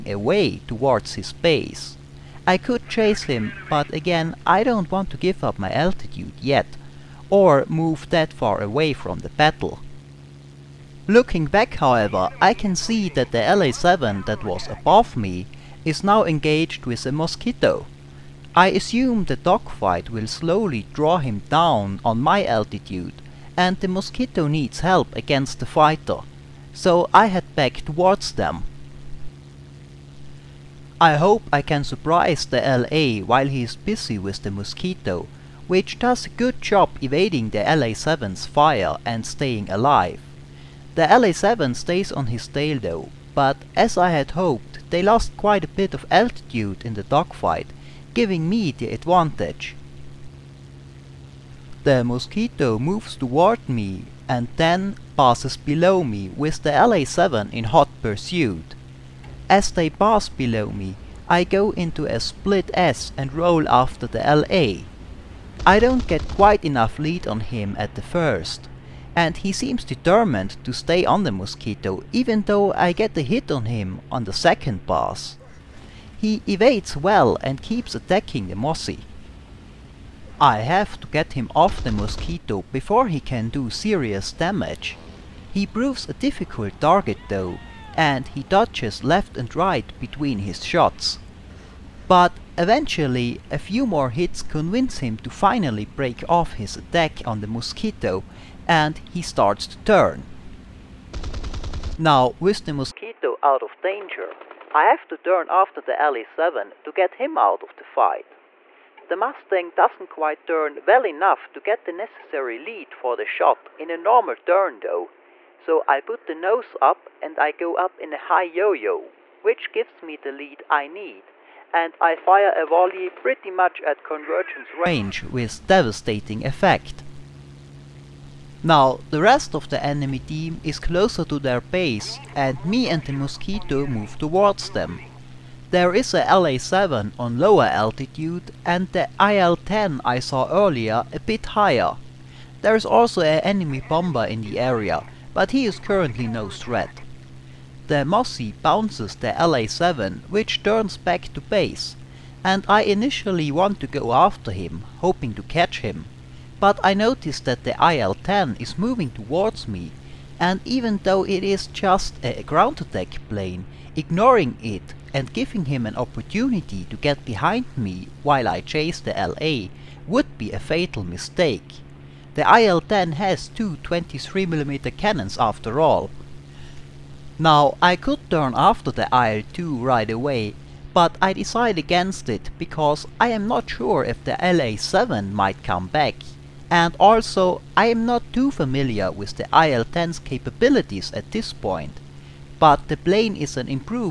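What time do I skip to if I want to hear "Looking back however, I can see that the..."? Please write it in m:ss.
0:11.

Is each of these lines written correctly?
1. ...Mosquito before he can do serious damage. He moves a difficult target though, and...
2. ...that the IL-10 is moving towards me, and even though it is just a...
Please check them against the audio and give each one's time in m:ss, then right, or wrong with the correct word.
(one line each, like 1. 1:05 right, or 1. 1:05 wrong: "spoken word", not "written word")
1. 1:21 wrong: "proves", not "moves"
2. 2:37 right.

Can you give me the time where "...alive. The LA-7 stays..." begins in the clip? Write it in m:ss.
0:39.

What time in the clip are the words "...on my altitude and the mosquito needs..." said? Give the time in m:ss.
0:22.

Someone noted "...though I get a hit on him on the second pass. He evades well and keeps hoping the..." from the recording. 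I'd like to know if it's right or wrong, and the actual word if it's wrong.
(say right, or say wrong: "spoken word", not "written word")
wrong: "attacking", not "hoping".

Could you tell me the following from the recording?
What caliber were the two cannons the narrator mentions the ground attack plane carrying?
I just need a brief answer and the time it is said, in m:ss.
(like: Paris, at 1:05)
23mm, at 2:53.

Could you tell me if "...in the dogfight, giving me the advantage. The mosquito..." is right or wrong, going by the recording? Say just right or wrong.
right.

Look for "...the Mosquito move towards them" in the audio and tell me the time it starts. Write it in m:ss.
2:13.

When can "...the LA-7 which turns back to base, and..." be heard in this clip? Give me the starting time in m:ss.
2:29.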